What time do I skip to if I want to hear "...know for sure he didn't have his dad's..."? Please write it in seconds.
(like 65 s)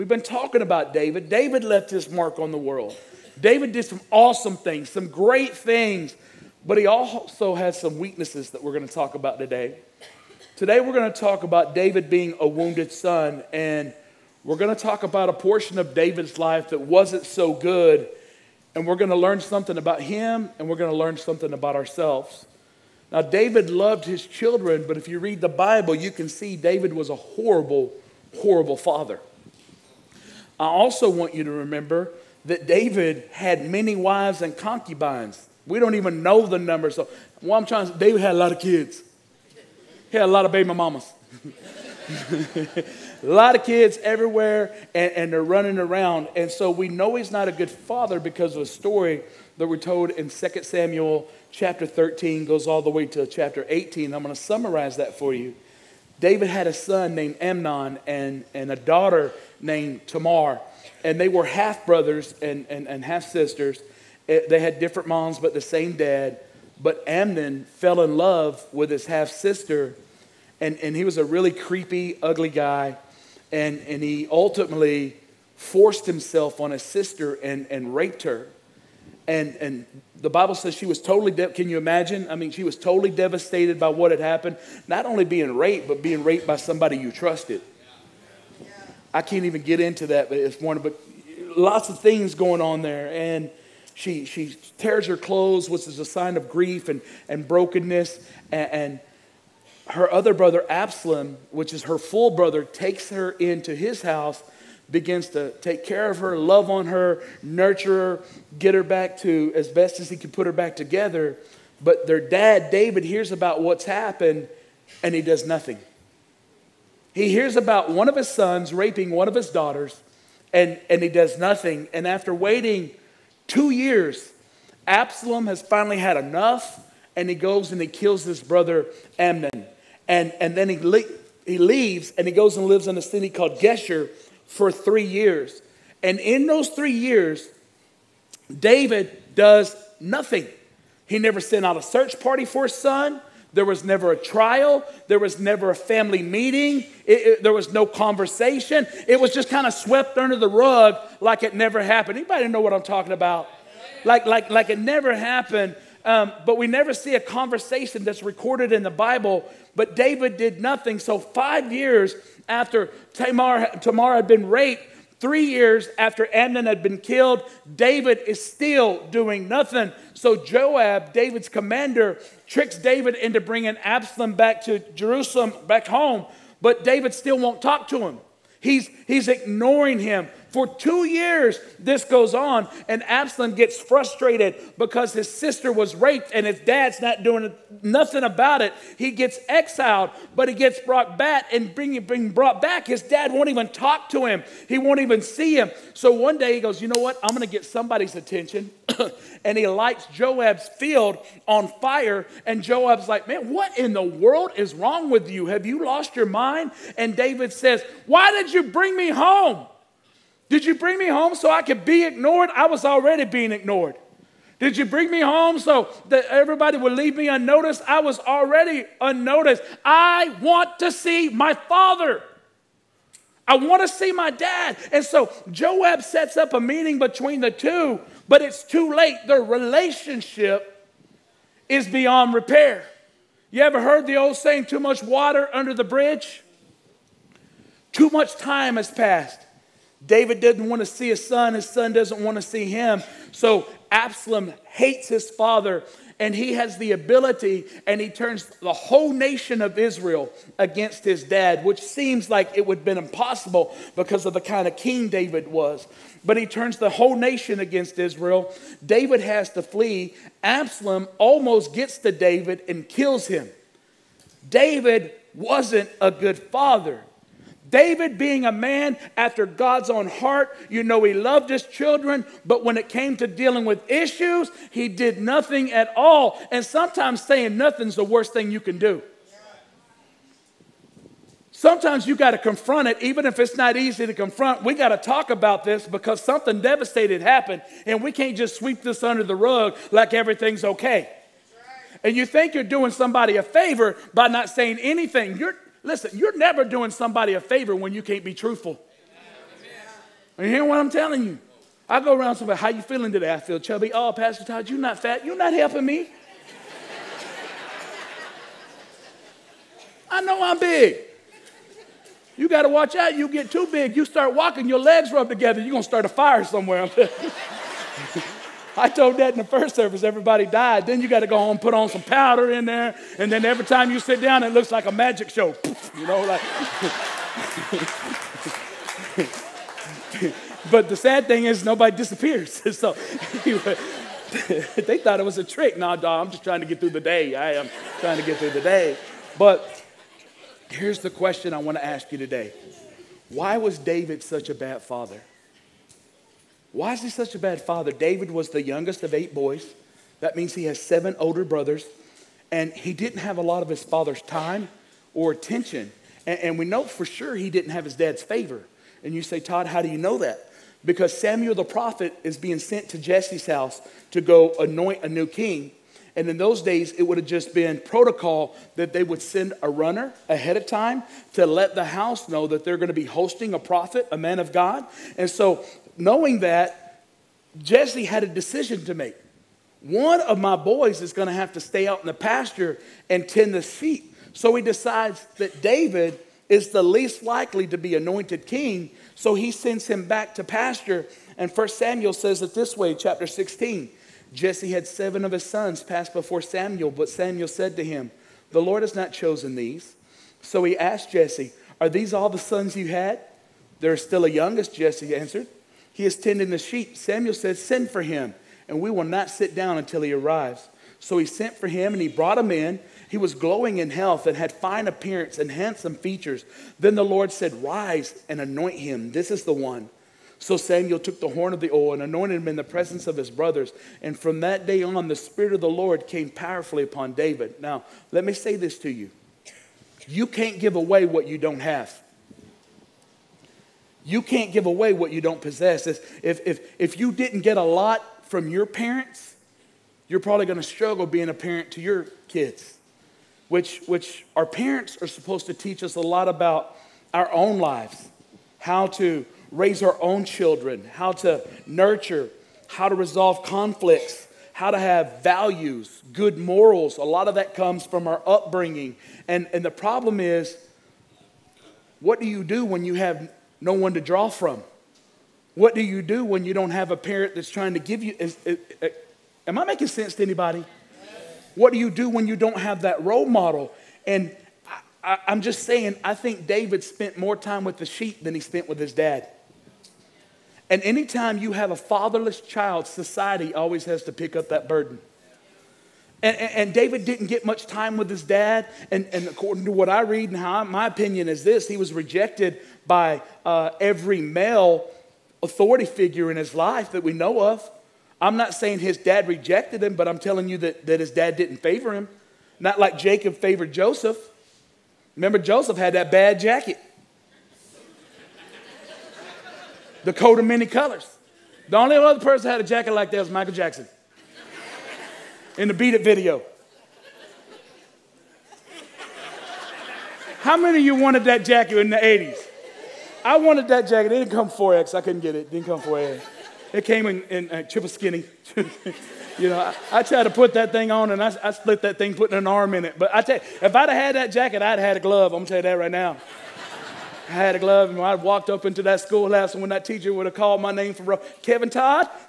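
356 s.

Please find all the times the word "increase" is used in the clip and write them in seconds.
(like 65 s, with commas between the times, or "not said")
not said.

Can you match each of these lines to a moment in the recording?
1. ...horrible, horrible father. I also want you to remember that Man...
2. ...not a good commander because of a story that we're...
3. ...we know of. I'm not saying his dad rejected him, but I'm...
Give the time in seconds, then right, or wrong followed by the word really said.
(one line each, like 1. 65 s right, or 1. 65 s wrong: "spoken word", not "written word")
1. 27 s wrong: "David", not "Man"
2. 47 s wrong: "father", not "commander"
3. 497 s right.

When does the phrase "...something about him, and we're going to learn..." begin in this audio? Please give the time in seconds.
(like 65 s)
19 s.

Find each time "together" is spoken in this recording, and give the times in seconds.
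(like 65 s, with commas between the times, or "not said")
110 s, 315 s.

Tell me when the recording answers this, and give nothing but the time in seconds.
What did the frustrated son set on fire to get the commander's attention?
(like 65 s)
200 s.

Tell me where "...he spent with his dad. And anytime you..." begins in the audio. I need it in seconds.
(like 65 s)
478 s.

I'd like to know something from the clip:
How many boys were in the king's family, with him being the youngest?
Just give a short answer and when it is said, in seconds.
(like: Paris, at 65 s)
8, at 349 s.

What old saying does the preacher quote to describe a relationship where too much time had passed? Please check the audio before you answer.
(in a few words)
Too much water under the bridge.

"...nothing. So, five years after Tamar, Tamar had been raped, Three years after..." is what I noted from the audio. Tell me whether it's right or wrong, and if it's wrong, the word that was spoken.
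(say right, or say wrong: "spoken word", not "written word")
right.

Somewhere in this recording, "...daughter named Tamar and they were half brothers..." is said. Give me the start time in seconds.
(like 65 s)
58 s.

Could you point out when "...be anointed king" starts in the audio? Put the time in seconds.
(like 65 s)
387 s.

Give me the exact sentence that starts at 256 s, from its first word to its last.
But he turns the whole nation against Israel.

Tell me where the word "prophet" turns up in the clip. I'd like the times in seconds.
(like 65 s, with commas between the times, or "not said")
361 s, 373 s.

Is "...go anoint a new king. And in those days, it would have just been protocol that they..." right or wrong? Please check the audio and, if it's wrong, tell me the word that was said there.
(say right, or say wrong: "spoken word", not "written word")
right.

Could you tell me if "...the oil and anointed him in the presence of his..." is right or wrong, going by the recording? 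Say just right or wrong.
right.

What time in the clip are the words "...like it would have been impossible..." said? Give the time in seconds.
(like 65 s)
252 s.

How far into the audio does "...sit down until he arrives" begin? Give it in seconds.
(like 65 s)
409 s.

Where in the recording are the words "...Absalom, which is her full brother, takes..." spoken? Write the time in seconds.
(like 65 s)
100 s.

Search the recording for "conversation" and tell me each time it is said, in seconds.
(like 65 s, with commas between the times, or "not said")
147 s, 157 s.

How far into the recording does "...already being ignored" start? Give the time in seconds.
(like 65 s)
212 s.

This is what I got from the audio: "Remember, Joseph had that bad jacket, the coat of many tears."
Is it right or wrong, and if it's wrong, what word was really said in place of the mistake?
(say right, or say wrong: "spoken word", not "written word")
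wrong: "colors", not "tears".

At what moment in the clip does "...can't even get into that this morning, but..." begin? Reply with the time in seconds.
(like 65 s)
89 s.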